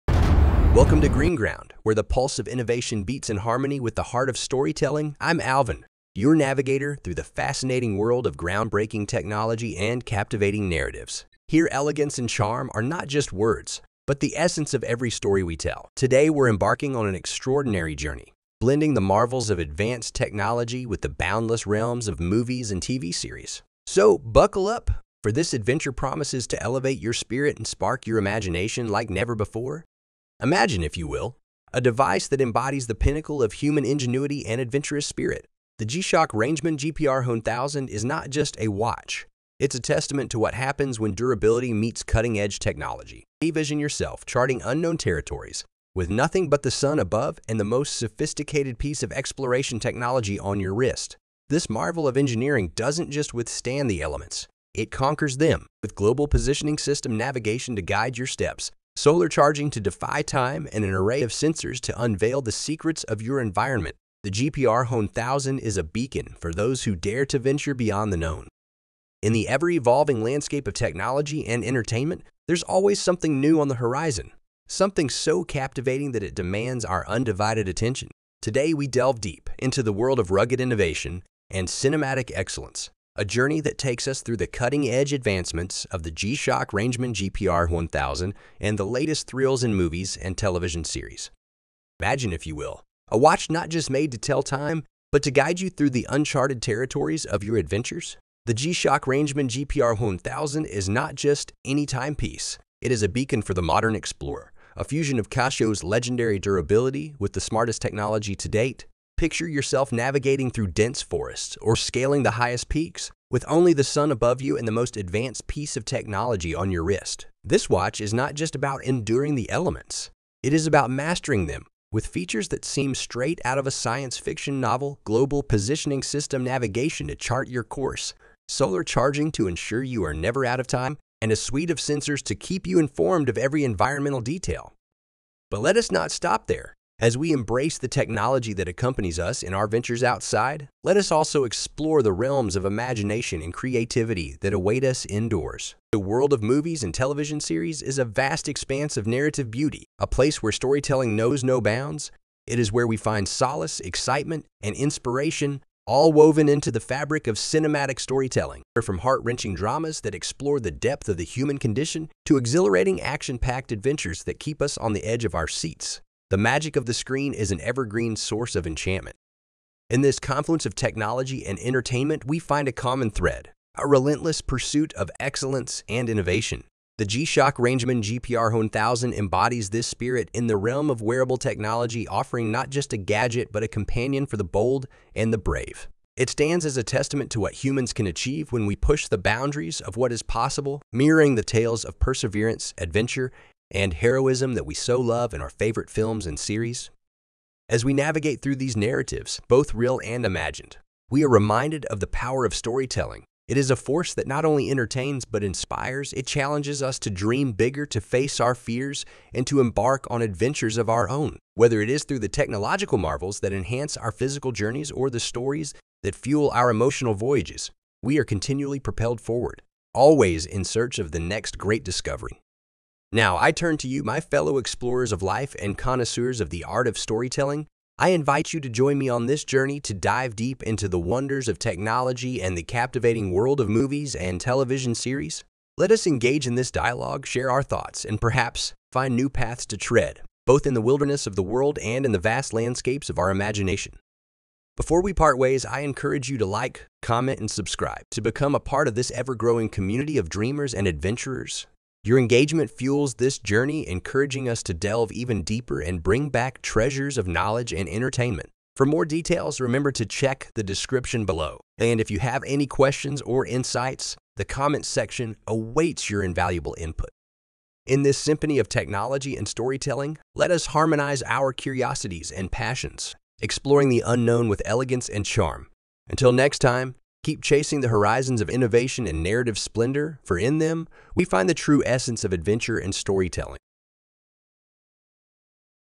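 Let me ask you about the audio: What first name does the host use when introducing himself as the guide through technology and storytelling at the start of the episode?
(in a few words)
Alvin.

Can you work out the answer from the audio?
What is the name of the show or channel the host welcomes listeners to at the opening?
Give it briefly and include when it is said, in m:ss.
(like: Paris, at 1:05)
Green Ground, at 0:01.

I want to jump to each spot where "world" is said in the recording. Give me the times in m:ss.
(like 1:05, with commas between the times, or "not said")
0:07, 1:19, 2:25, 3:53, 4:01.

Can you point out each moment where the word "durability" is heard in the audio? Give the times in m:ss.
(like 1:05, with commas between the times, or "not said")
0:41, 1:46.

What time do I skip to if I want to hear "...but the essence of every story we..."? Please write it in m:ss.
0:14.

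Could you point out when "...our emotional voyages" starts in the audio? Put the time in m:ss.
3:36.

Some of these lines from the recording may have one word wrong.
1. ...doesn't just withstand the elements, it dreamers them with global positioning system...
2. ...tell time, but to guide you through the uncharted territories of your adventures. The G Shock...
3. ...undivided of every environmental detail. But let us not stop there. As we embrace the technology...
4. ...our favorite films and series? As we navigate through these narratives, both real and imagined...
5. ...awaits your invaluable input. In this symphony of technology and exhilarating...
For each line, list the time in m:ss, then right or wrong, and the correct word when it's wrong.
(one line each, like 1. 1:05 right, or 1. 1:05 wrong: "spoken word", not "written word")
1. 0:52 wrong: "conquers", not "dreamers"
2. 1:34 right
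3. 2:12 wrong: "informed", not "undivided"
4. 3:15 right
5. 4:25 wrong: "storytelling", not "exhilarating".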